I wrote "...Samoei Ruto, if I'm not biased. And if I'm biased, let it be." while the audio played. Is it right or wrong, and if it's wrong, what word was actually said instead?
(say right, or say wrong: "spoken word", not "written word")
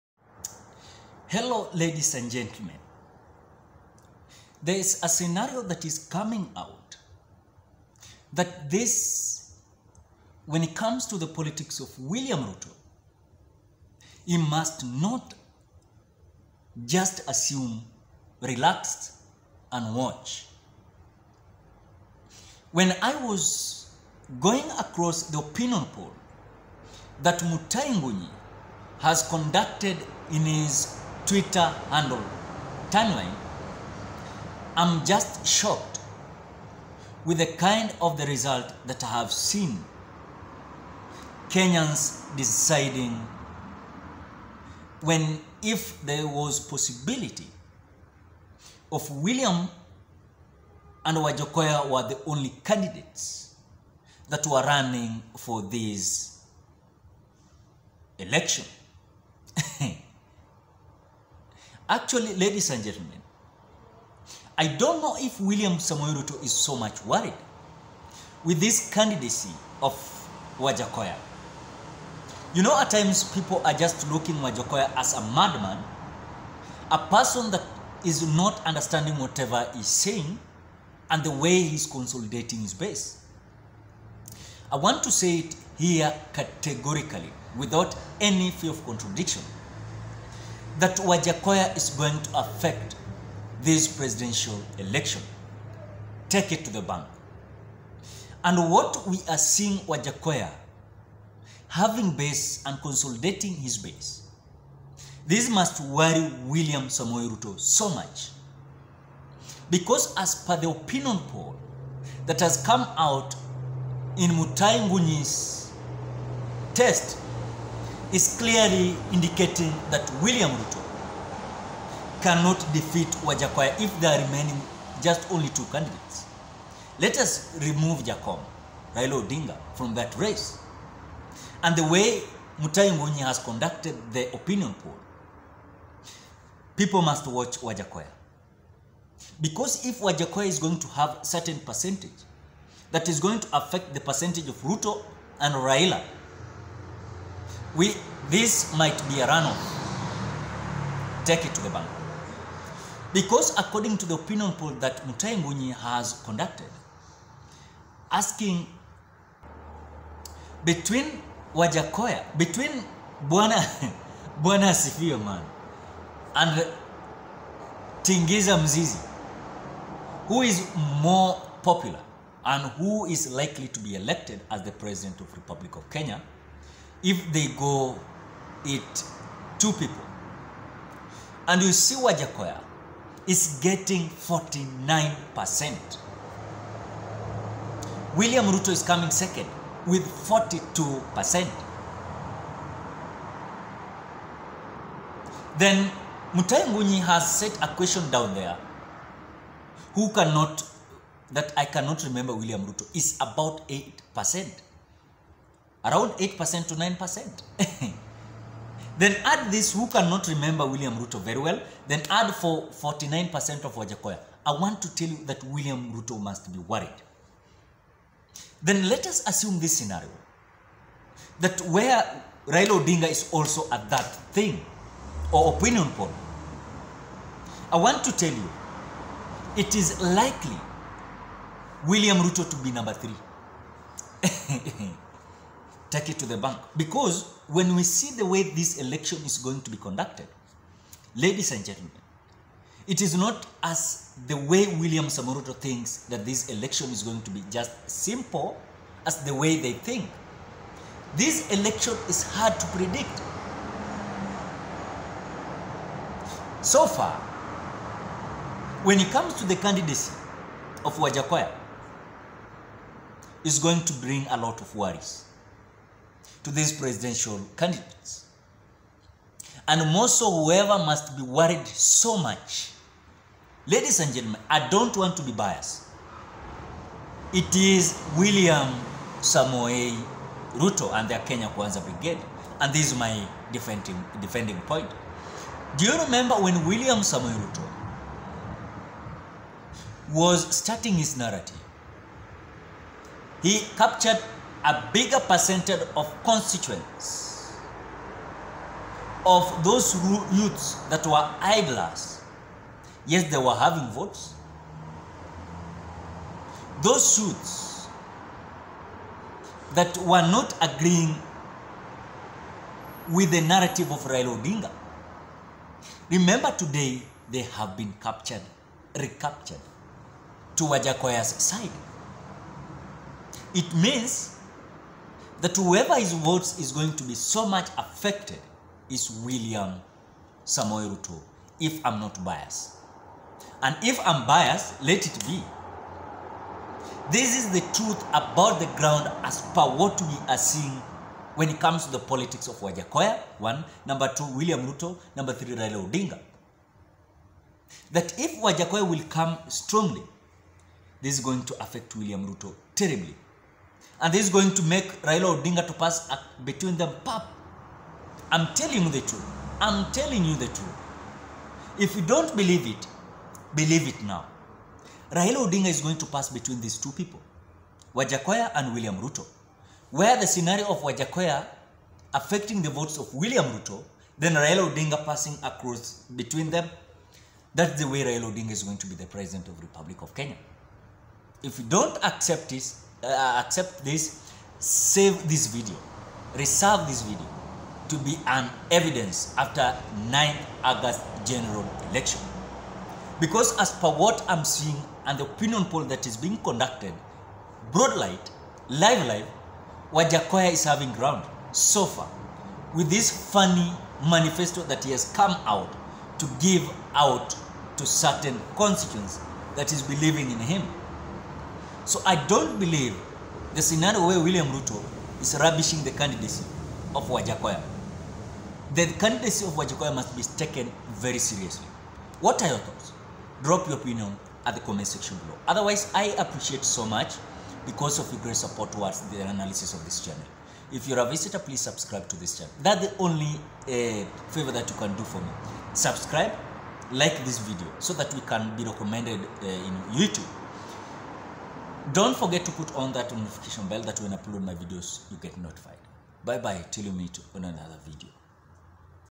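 right.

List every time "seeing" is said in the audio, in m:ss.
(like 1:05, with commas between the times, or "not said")
1:39, 5:40, 6:34.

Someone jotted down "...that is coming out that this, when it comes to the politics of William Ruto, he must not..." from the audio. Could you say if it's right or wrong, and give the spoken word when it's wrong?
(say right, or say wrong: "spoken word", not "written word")
right.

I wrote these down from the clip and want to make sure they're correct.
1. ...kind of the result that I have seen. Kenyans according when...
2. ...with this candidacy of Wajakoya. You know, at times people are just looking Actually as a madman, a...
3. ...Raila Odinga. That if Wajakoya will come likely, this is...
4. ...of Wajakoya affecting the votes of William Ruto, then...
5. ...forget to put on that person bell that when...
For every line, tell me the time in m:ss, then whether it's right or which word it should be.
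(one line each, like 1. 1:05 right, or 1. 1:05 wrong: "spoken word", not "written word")
1. 0:37 wrong: "deciding", not "according"
2. 1:08 wrong: "Wajakoya", not "Actually"
3. 5:45 wrong: "strongly", not "likely"
4. 6:10 right
5. 7:22 wrong: "notification", not "person".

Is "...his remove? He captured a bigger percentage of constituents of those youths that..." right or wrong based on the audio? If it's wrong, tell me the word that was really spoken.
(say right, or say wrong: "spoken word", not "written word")
wrong: "narrative", not "remove".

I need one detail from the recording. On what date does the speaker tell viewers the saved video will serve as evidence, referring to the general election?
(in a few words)
9th August.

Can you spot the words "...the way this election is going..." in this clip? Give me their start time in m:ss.
3:58.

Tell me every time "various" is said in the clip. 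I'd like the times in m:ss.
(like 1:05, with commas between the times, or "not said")
not said.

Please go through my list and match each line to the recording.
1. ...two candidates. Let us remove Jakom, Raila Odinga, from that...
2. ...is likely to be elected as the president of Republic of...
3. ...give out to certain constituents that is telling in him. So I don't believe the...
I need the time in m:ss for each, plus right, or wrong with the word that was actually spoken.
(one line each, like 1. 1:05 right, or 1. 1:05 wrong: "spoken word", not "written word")
1. 2:05 right
2. 2:53 right
3. 6:46 wrong: "believing", not "telling".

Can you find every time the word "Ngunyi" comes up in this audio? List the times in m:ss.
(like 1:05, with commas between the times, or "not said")
1:54, 2:12, 2:35, 3:16.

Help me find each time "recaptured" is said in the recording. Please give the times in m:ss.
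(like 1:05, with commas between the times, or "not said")
5:18.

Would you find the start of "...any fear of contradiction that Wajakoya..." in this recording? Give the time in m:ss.
1:28.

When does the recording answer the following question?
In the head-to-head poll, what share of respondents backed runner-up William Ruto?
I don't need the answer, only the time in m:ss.
3:10.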